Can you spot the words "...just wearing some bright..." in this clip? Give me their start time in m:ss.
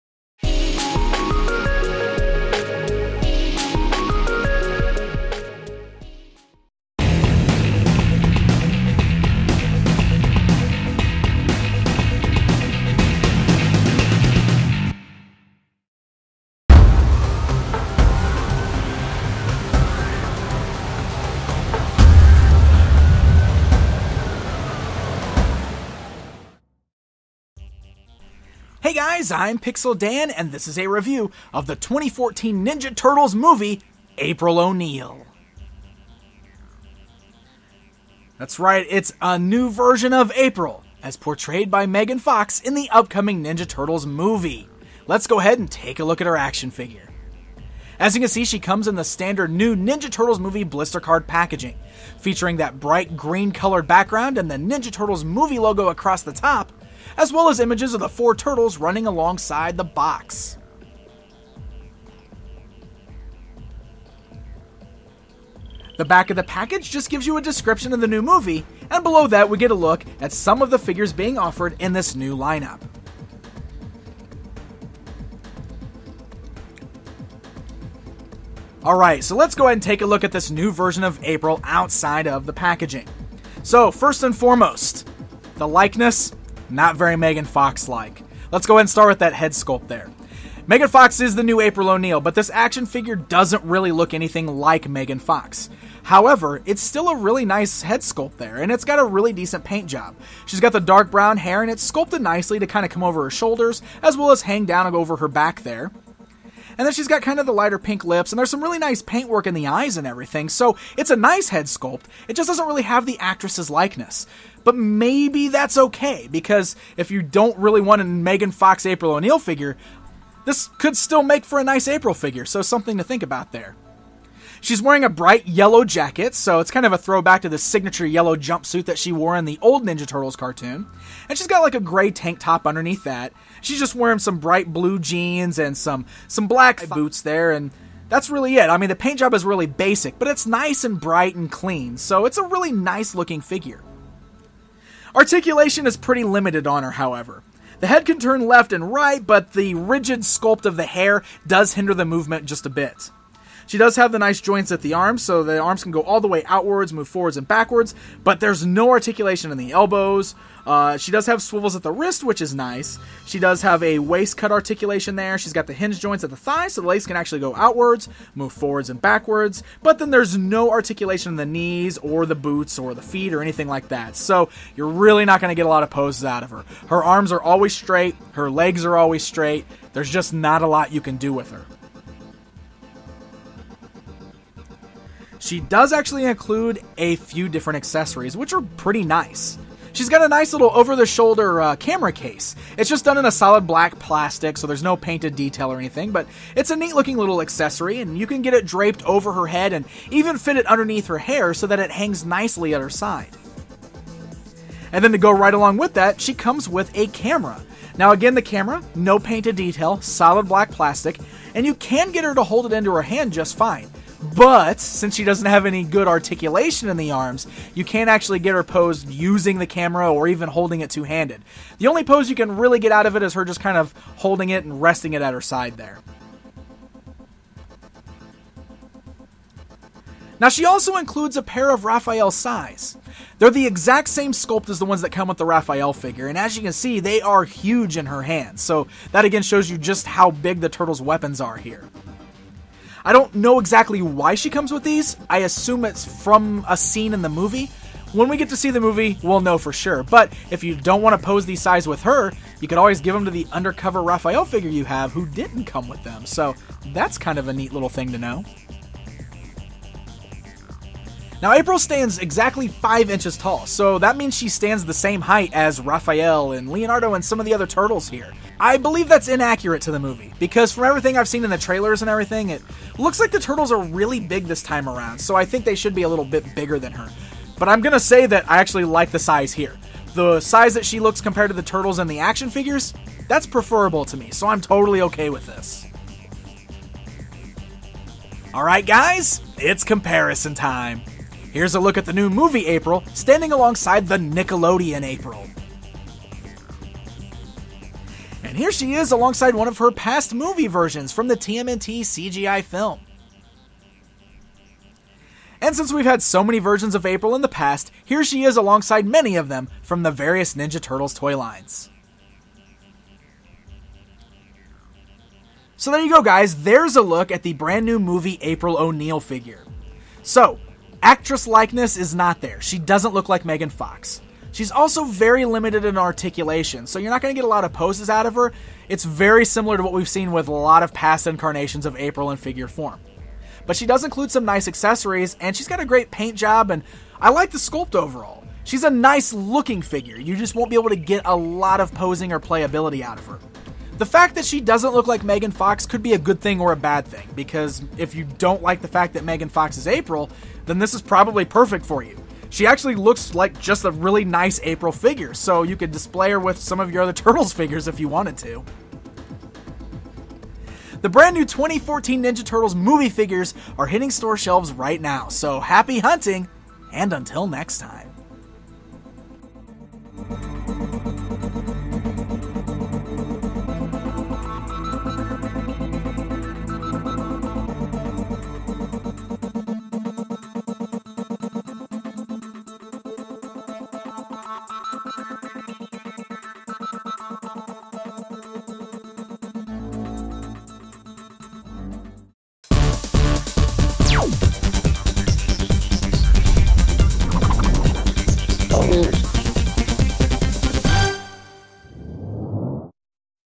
2:13.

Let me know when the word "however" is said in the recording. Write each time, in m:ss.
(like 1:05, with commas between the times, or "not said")
1:36, 2:26.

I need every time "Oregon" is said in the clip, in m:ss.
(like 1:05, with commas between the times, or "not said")
not said.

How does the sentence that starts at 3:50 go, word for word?
Now, she also includes a pair of Raphael sais.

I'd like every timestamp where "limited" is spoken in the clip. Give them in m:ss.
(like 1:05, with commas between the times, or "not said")
2:26, 5:25.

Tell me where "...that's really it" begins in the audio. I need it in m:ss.
2:18.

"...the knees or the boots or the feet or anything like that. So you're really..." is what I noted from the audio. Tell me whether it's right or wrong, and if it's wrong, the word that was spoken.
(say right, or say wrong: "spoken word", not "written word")
right.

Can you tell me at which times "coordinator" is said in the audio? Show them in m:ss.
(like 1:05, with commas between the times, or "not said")
not said.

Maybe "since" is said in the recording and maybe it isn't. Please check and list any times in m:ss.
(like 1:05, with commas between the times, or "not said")
3:34, 5:05.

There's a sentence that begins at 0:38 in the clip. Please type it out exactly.
That's right, it's a new version of April, as portrayed by Megan Fox in the upcoming Ninja Turtles movie.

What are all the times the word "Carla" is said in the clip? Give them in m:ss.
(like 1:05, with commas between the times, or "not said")
not said.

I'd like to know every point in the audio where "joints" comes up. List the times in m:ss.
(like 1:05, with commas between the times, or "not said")
2:34, 2:45.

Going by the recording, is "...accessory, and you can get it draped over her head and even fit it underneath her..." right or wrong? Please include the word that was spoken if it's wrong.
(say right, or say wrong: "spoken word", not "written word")
right.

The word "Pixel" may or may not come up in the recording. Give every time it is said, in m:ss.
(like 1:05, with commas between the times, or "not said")
0:29.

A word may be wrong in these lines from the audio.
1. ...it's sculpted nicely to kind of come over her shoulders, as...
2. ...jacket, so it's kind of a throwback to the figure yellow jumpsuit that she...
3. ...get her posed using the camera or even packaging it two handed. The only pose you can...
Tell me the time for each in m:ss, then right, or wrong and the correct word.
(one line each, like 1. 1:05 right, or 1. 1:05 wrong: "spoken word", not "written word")
1. 1:41 right
2. 2:05 wrong: "signature", not "figure"
3. 3:38 wrong: "holding", not "packaging".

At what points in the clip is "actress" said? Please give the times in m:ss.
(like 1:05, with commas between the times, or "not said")
1:53, 5:21.